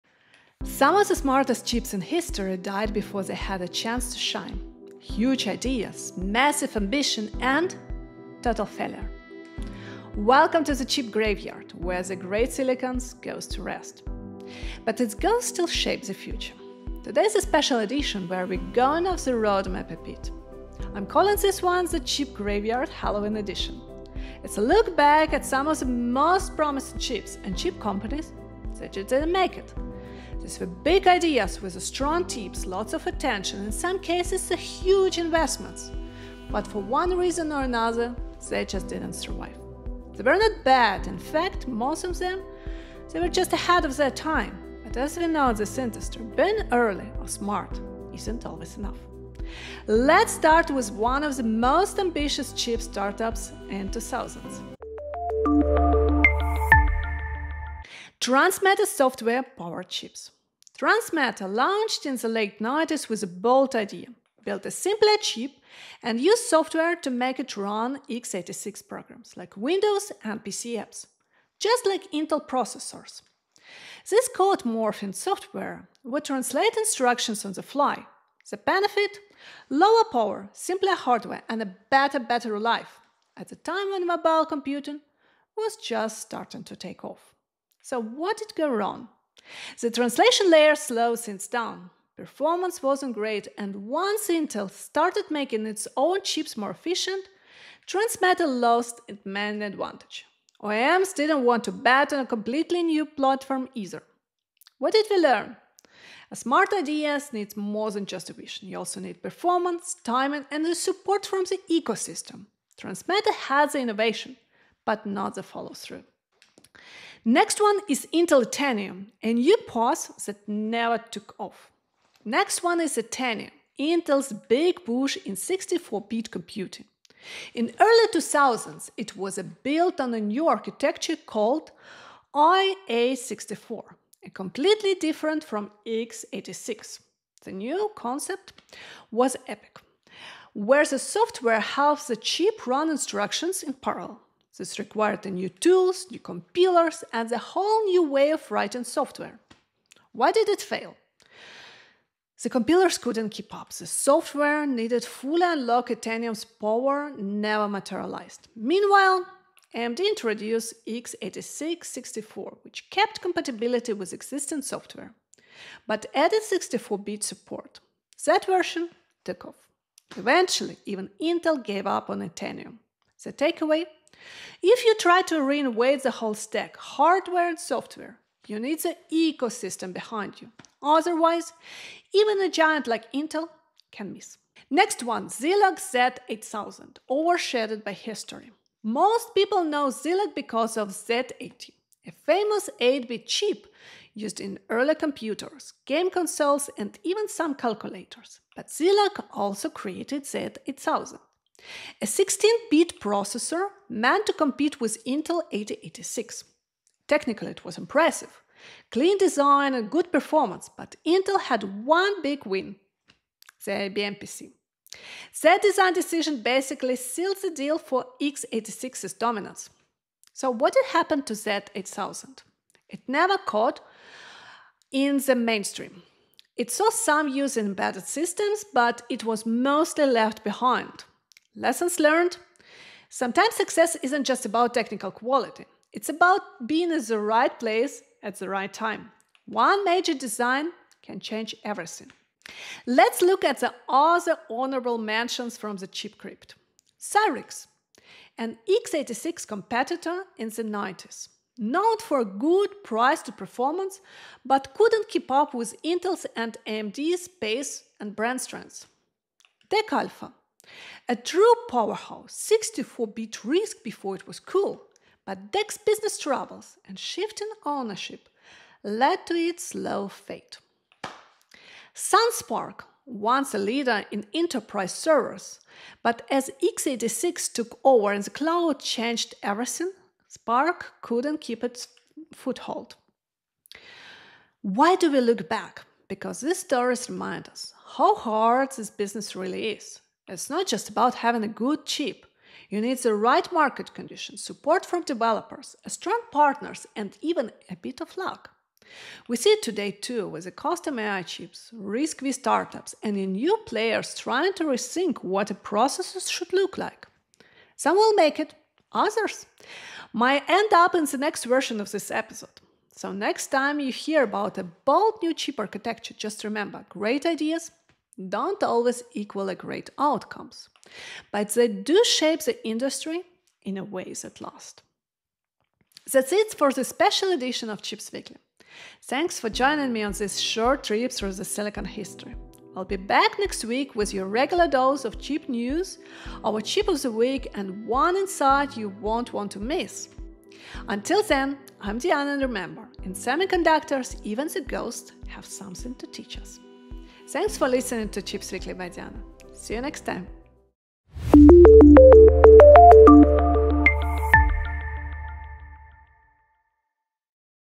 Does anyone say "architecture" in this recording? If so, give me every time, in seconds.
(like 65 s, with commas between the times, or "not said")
130 s, 315 s.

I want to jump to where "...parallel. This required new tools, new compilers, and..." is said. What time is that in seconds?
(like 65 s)
143 s.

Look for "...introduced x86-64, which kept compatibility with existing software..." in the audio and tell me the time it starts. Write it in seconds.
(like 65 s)
159 s.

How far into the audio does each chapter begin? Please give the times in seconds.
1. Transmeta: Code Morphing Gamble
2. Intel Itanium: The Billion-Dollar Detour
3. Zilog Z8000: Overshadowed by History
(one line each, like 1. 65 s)
1. 59 s
2. 116 s
3. 190 s.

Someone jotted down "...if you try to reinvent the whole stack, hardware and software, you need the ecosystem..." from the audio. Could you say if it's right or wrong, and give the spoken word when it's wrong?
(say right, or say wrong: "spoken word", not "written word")
right.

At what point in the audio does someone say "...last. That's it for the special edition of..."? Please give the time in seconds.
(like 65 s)
324 s.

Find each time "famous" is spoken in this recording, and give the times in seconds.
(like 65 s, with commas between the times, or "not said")
192 s.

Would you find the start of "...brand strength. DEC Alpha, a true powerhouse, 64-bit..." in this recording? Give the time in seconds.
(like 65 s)
258 s.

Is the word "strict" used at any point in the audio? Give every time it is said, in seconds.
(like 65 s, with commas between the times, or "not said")
not said.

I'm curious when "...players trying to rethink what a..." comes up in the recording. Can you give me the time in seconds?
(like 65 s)
303 s.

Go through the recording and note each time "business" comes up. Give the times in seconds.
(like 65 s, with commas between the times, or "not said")
265 s, 288 s.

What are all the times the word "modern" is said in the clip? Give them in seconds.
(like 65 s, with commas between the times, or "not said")
not said.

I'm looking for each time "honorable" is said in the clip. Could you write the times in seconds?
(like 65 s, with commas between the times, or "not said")
244 s.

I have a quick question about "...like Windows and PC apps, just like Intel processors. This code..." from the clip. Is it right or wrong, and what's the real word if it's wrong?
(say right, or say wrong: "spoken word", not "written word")
right.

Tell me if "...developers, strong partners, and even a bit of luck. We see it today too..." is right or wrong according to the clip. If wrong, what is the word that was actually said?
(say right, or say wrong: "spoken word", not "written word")
right.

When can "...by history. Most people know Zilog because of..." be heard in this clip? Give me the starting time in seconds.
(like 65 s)
187 s.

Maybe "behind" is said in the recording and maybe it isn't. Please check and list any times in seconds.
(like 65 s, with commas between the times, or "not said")
179 s, 230 s.